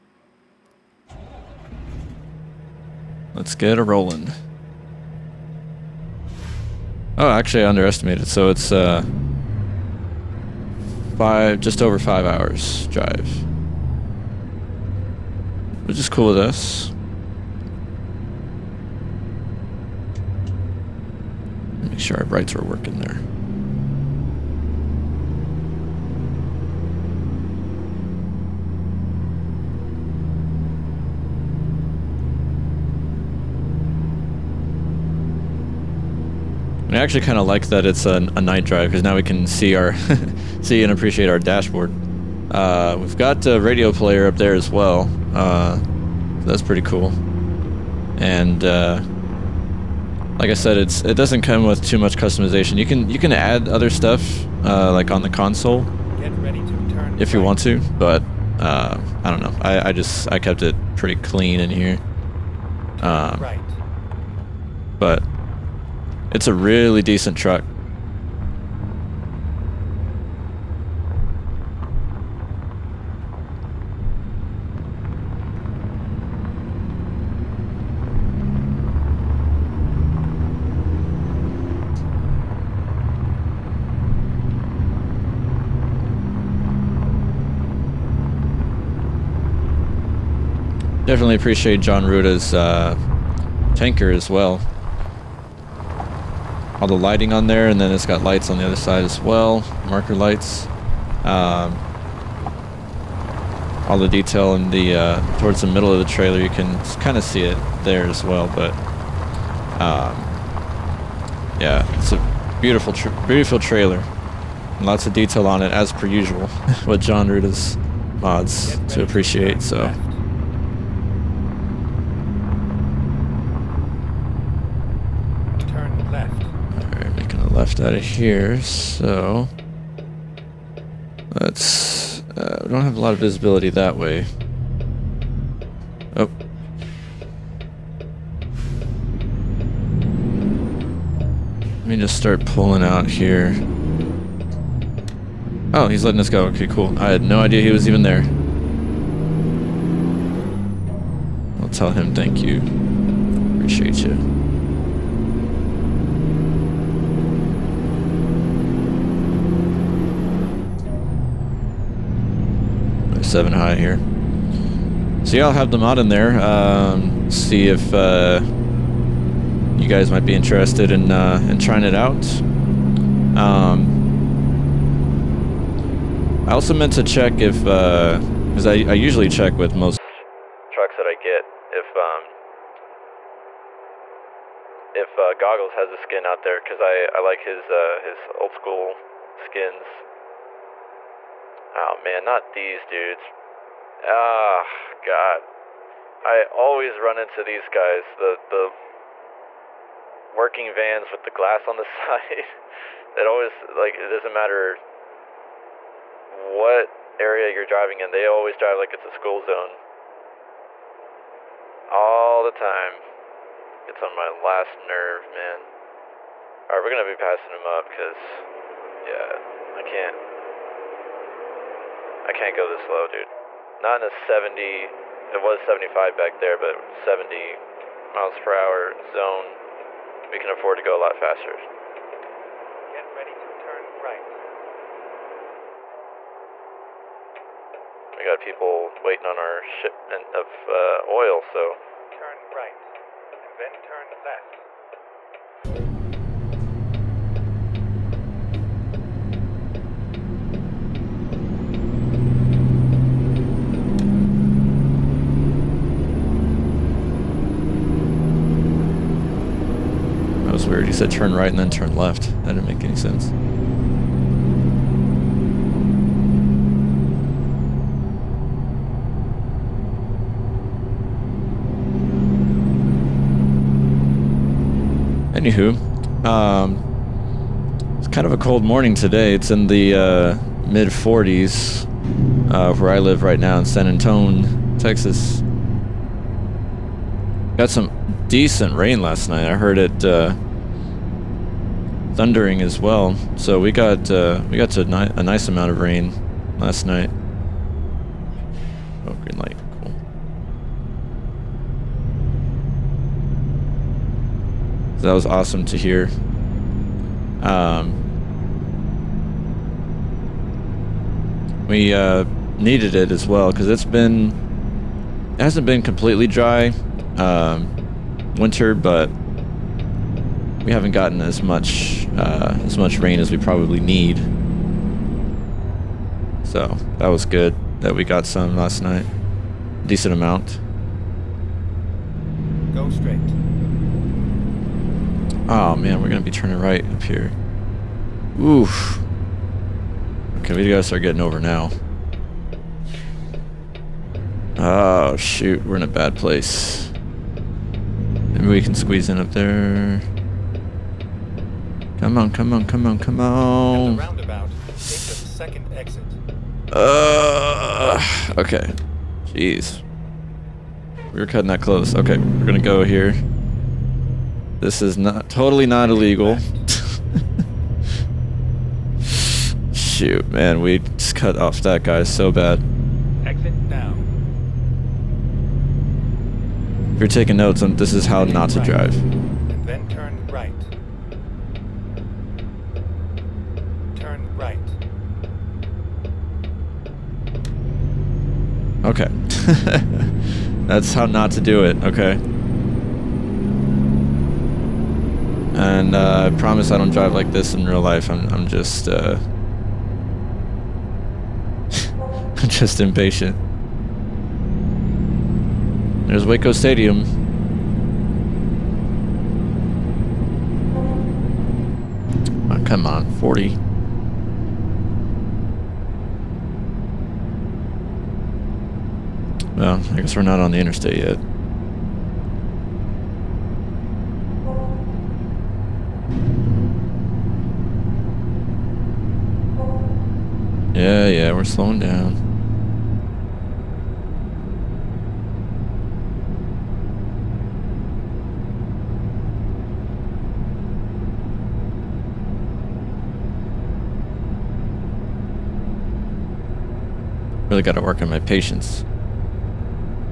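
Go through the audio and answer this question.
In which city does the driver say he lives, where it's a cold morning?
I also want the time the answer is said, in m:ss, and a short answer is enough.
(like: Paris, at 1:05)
San Antonio, Texas, at 4:43.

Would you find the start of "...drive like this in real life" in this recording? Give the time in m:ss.
6:36.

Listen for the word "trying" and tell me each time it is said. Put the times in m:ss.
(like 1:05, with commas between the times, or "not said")
2:51.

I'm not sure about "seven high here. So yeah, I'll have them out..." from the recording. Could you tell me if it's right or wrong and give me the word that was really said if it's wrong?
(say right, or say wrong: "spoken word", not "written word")
right.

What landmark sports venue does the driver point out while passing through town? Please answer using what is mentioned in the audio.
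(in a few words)
Waco Stadium.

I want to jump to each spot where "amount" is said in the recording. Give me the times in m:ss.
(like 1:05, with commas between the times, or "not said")
4:55, 5:30.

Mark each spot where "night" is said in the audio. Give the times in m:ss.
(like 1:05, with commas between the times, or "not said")
0:38, 4:49, 4:56, 5:28.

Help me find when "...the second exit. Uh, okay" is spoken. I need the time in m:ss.
5:54.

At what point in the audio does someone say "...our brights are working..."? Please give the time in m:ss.
0:22.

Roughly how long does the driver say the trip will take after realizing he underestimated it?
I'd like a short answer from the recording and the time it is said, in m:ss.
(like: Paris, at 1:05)
Just over 5 hours, at 0:11.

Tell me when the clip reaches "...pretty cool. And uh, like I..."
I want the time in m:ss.
0:46.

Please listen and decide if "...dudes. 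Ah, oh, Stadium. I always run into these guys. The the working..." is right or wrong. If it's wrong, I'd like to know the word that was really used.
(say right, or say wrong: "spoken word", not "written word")
wrong: "God", not "Stadium".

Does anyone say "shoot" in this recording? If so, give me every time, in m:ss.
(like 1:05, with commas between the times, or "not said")
5:45, 6:09.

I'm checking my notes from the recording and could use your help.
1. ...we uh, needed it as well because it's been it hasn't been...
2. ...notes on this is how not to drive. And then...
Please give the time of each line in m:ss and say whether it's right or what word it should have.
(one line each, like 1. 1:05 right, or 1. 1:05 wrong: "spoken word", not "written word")
1. 5:11 right
2. 6:17 right.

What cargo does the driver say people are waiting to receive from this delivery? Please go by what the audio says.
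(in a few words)
Oil.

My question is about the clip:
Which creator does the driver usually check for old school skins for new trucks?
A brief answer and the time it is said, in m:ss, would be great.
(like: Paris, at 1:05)
Goggles, at 3:05.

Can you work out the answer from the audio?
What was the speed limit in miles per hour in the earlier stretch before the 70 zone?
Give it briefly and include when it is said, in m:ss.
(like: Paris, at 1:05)
75, at 3:45.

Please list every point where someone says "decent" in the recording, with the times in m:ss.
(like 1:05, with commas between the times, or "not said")
1:07, 4:48, 5:29.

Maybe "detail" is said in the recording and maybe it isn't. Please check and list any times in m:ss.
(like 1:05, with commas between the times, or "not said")
1:44, 1:55.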